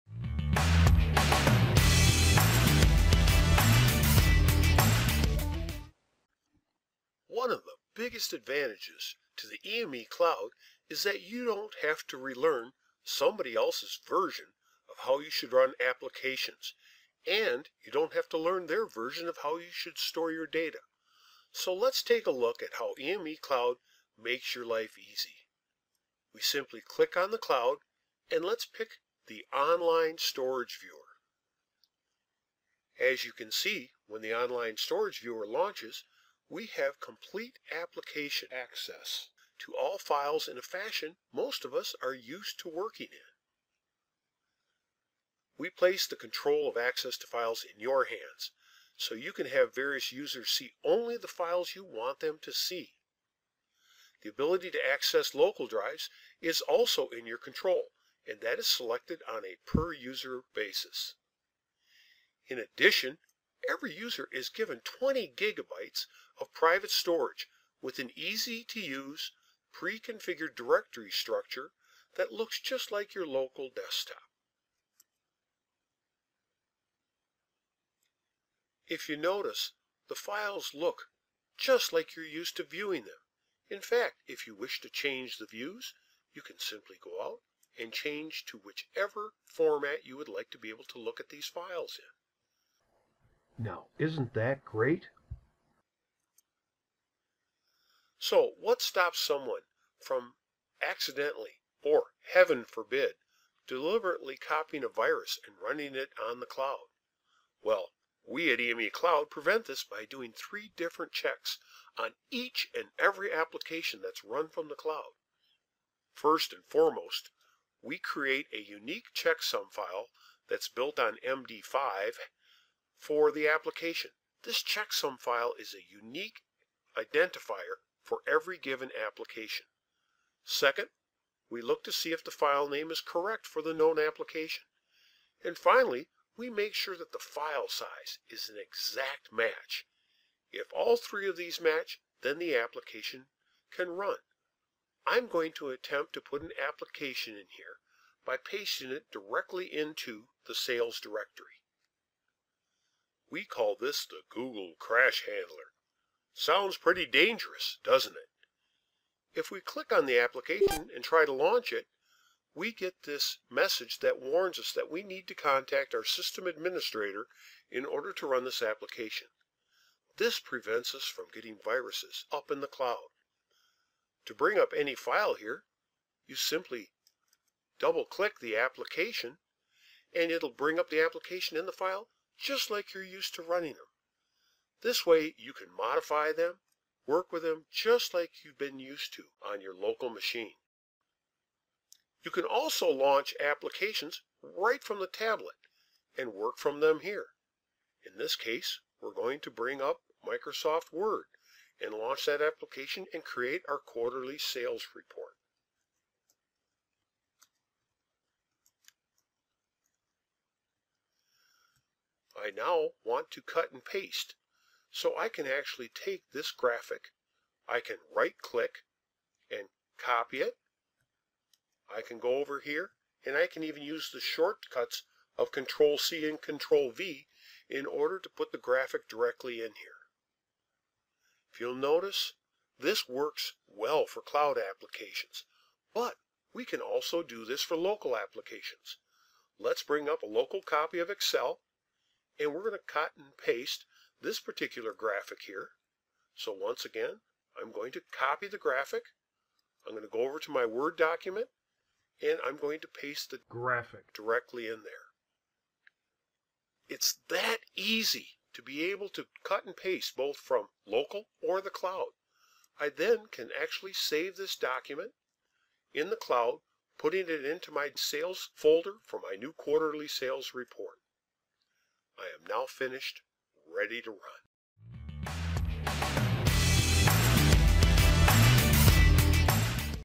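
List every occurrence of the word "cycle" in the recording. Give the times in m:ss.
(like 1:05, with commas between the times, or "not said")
not said.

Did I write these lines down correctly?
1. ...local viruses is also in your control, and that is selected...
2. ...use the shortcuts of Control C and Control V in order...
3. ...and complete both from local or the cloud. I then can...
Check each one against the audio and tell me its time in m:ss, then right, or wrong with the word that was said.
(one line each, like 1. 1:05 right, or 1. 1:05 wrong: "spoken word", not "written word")
1. 0:55 wrong: "drives", not "viruses"
2. 3:43 right
3. 4:19 wrong: "paste", not "complete".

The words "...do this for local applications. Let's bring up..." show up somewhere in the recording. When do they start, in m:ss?
3:57.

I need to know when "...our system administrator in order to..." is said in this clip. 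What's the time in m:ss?
2:45.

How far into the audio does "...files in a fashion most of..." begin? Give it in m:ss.
0:39.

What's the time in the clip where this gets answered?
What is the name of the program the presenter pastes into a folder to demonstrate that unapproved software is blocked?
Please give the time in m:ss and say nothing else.
2:34.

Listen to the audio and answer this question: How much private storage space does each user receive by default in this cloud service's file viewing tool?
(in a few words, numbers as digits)
20 gigabytes.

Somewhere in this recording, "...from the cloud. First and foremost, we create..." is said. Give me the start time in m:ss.
1:54.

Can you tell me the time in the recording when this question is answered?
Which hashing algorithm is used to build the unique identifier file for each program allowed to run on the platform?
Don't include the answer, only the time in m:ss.
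2:01.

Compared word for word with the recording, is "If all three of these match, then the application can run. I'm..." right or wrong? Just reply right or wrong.
right.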